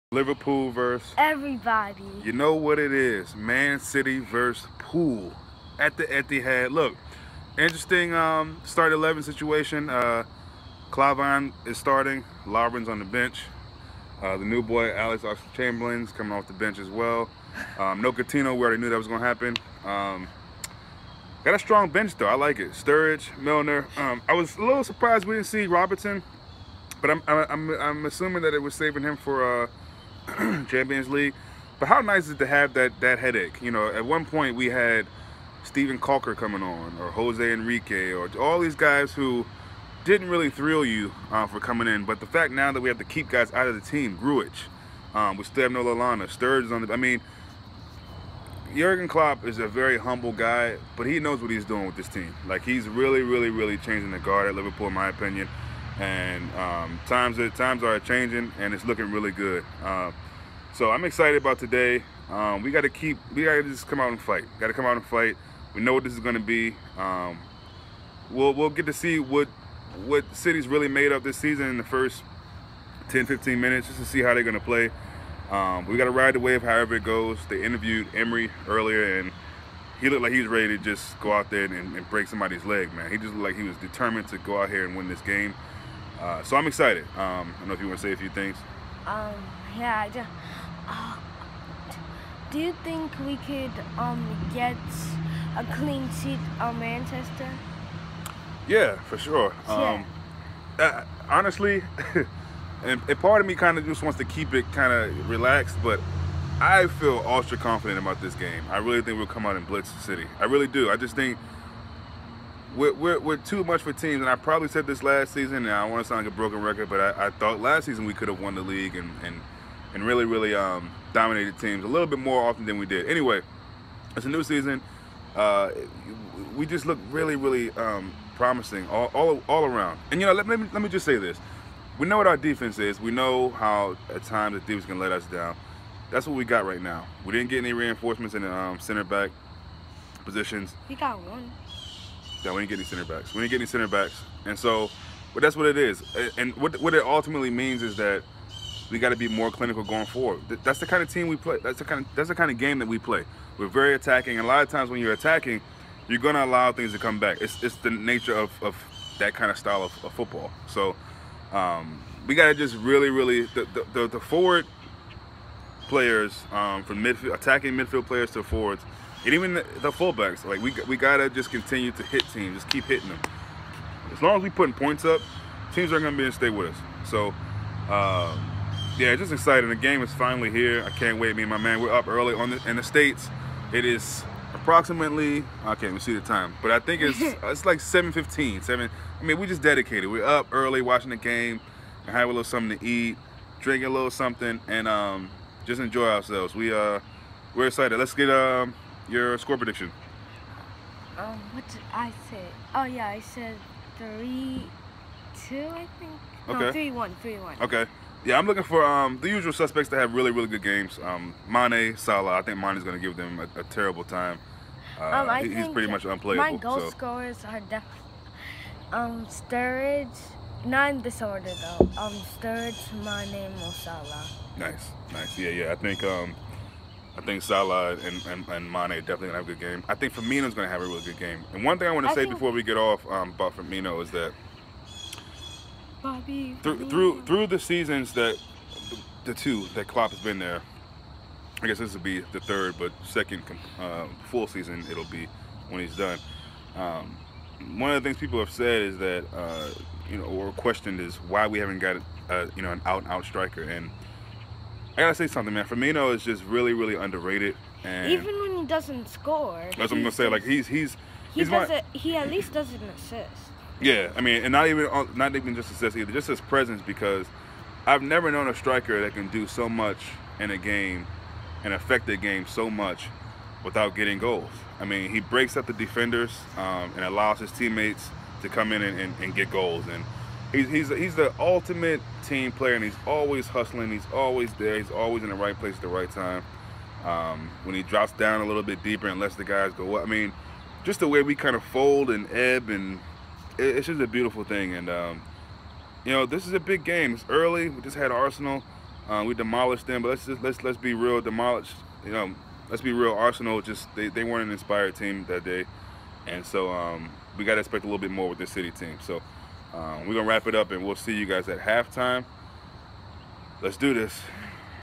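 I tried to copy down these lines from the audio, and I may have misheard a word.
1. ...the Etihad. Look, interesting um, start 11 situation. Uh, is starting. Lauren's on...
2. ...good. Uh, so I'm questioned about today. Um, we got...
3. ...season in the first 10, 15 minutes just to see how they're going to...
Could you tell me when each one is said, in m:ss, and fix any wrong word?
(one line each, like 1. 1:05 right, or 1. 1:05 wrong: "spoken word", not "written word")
1. 0:05 right
2. 0:59 wrong: "excited", not "questioned"
3. 1:11 right.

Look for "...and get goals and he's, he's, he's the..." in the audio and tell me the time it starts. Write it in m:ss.
4:39.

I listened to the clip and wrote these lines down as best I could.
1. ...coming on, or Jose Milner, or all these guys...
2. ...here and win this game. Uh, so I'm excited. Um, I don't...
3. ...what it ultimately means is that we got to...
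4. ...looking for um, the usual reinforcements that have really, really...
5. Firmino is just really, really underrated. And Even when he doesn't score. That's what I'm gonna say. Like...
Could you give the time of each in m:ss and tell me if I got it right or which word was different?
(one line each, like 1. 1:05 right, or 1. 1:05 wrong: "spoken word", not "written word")
1. 0:36 wrong: "Enrique", not "Milner"
2. 1:24 right
3. 2:26 right
4. 3:28 wrong: "suspects", not "reinforcements"
5. 4:15 right.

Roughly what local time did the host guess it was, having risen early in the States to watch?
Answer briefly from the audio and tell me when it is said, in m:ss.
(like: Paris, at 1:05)
7:15, at 3:07.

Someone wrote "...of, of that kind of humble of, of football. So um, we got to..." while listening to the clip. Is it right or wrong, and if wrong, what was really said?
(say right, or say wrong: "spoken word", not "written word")
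wrong: "style", not "humble".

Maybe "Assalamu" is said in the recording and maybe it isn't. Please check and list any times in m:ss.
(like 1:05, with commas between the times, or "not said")
not said.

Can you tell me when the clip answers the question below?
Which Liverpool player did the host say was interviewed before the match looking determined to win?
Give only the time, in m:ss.
1:18.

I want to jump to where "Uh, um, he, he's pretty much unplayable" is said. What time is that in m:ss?
3:34.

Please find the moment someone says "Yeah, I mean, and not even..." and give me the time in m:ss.
4:23.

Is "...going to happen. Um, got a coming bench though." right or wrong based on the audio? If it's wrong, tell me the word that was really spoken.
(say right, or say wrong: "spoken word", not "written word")
wrong: "strong", not "coming".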